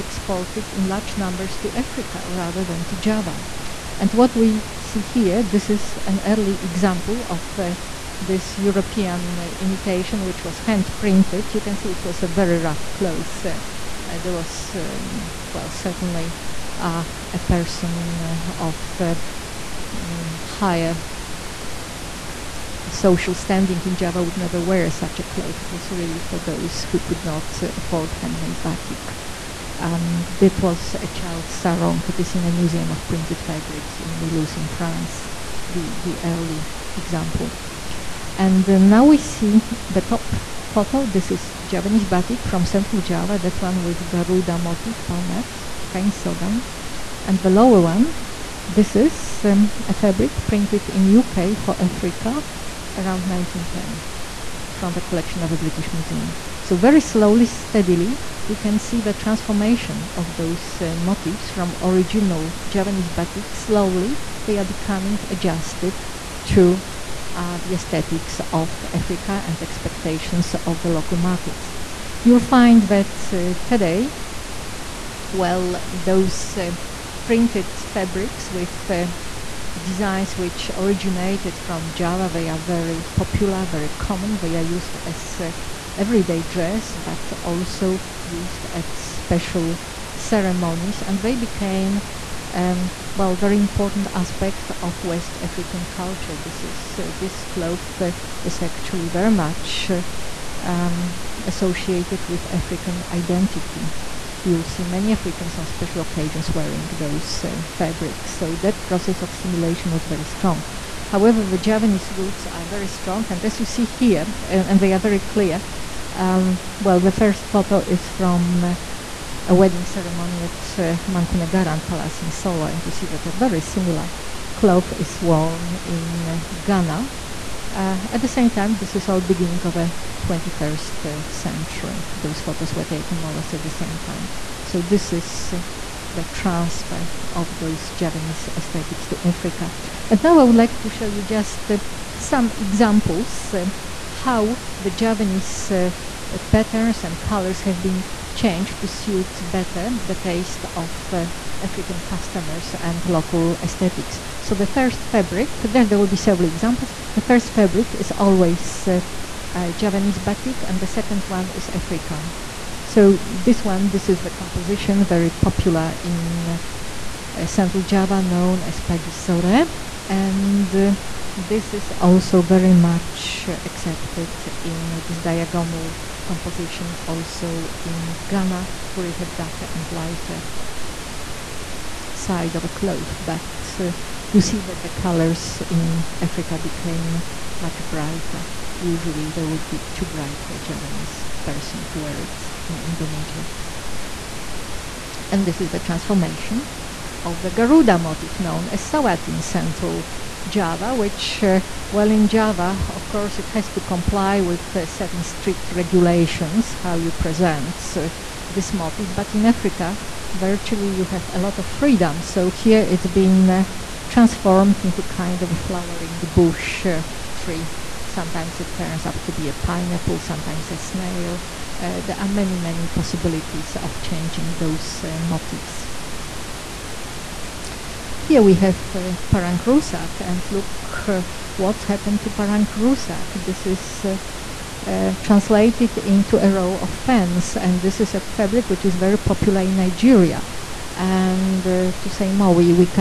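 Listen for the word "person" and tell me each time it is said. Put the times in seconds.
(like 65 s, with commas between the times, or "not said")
17 s, 191 s.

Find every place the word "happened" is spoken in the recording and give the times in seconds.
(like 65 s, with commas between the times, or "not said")
231 s.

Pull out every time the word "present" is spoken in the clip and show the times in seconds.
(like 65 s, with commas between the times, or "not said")
207 s.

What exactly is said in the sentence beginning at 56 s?
So very slowly, steadily, we can see the transformation of those uh, motifs from original Javanese batik.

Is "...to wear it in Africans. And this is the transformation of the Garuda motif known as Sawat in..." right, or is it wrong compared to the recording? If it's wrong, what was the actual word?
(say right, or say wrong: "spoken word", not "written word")
wrong: "Indonesia", not "Africans".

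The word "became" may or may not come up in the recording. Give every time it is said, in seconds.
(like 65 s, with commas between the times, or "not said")
91 s, 186 s.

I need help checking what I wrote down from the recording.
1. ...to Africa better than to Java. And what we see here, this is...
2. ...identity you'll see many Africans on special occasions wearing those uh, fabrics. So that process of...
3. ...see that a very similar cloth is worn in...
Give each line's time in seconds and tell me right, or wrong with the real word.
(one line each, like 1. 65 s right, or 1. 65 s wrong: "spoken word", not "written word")
1. 1 s wrong: "rather", not "better"
2. 103 s right
3. 122 s right.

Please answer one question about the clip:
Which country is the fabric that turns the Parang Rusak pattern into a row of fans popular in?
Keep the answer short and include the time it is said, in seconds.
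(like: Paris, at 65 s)
Nigeria, at 239 s.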